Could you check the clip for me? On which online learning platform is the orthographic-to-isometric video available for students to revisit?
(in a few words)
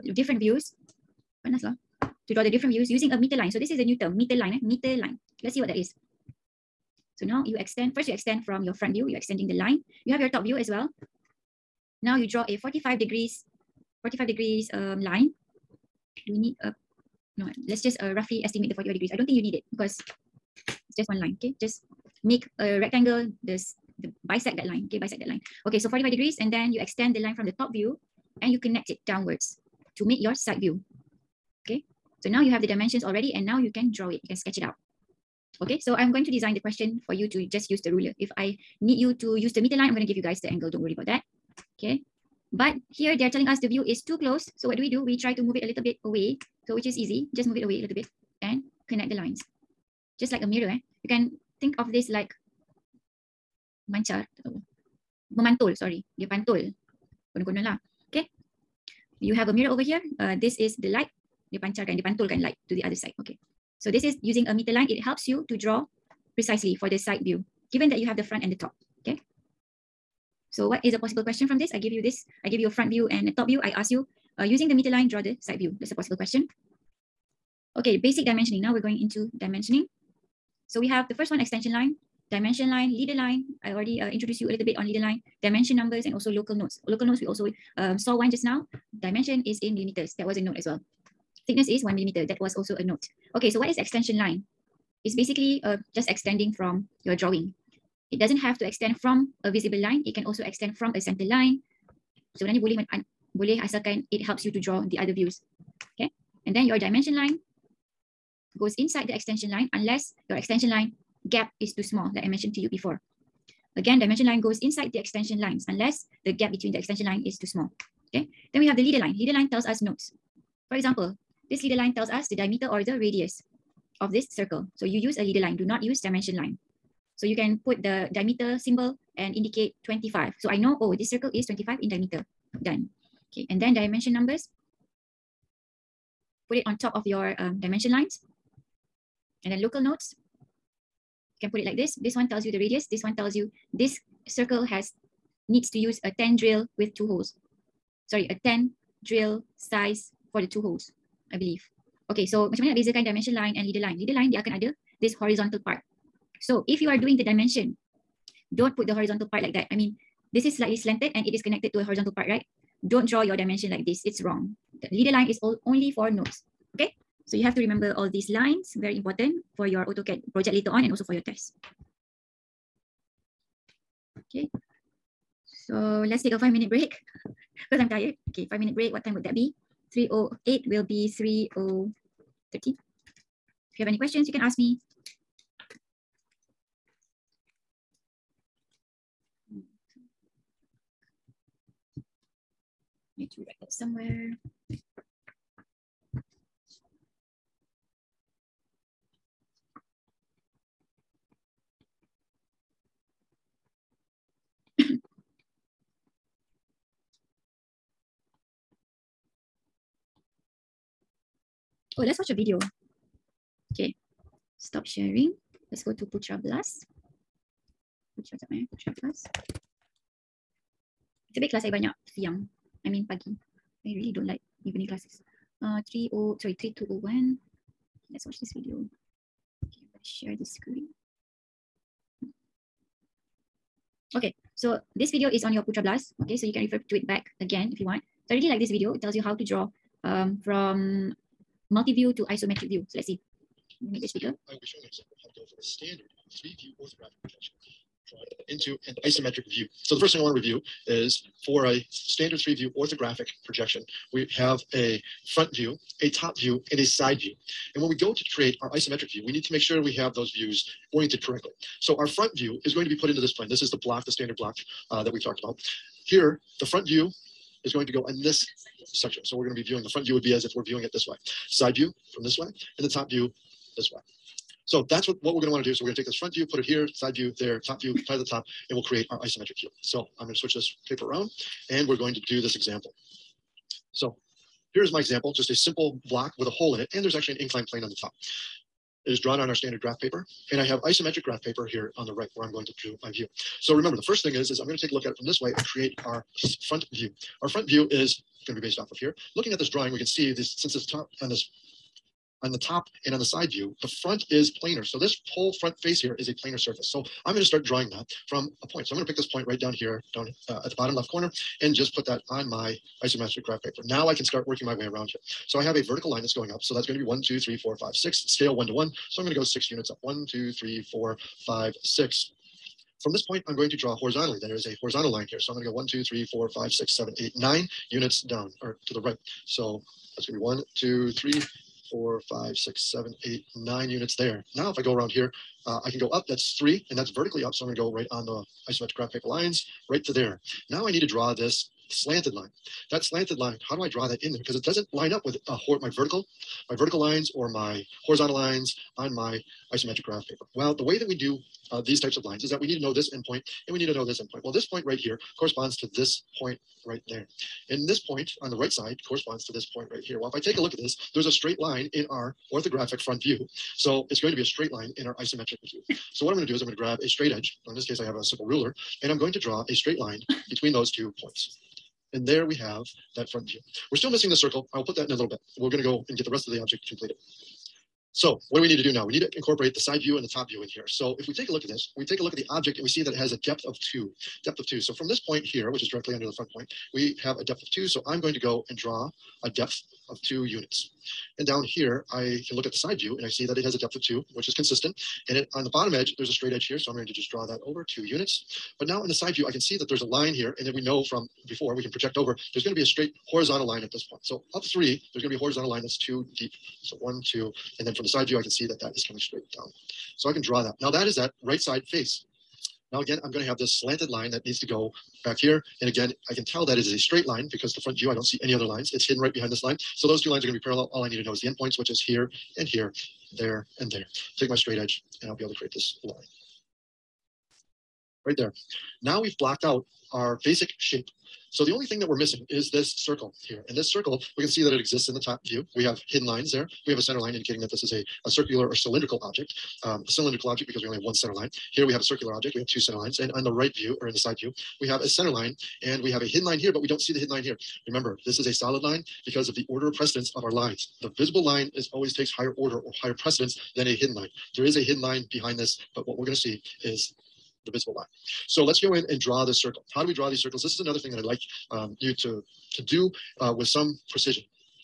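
PutraBLAST.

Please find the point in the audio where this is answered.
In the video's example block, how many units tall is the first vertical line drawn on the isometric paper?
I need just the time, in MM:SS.
05:19.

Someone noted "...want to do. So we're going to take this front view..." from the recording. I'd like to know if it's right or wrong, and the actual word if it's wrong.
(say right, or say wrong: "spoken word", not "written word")
right.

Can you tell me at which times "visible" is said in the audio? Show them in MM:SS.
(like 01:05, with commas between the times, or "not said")
01:39, 07:31, 07:37.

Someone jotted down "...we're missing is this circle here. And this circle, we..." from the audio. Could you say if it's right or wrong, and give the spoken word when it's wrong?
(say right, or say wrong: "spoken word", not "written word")
right.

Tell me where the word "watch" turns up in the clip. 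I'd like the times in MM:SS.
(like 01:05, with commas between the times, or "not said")
03:32, 03:48.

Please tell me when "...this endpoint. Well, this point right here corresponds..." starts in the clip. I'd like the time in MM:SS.
05:54.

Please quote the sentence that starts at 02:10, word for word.
So I know, oh, this circle is 25 in diameter.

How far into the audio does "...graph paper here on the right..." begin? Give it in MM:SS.
04:51.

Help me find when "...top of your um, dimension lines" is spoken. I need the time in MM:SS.
02:16.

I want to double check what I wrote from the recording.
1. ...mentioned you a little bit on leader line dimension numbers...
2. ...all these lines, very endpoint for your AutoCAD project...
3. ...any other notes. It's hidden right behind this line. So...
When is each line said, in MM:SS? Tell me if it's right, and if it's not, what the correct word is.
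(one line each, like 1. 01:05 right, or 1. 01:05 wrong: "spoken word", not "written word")
1. 01:24 wrong: "introduced", not "mentioned"
2. 02:47 wrong: "important", not "endpoint"
3. 06:58 wrong: "lines", not "notes".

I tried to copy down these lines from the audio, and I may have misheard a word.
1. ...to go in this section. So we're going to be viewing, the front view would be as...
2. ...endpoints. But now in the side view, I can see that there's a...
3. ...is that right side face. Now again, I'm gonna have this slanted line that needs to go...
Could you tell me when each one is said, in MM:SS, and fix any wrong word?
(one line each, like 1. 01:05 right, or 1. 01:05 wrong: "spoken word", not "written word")
1. 04:27 right
2. 06:38 wrong: "units", not "endpoints"
3. 06:51 right.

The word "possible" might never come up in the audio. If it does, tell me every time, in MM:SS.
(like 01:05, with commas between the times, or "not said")
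01:10, 01:15.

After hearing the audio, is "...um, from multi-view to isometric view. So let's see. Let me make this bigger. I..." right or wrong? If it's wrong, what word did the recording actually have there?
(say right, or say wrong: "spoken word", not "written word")
right.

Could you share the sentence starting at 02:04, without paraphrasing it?
So you use a leader line, do not use dimension line.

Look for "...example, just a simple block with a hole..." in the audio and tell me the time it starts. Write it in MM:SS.
04:44.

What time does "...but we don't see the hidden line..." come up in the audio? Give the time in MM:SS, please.
07:26.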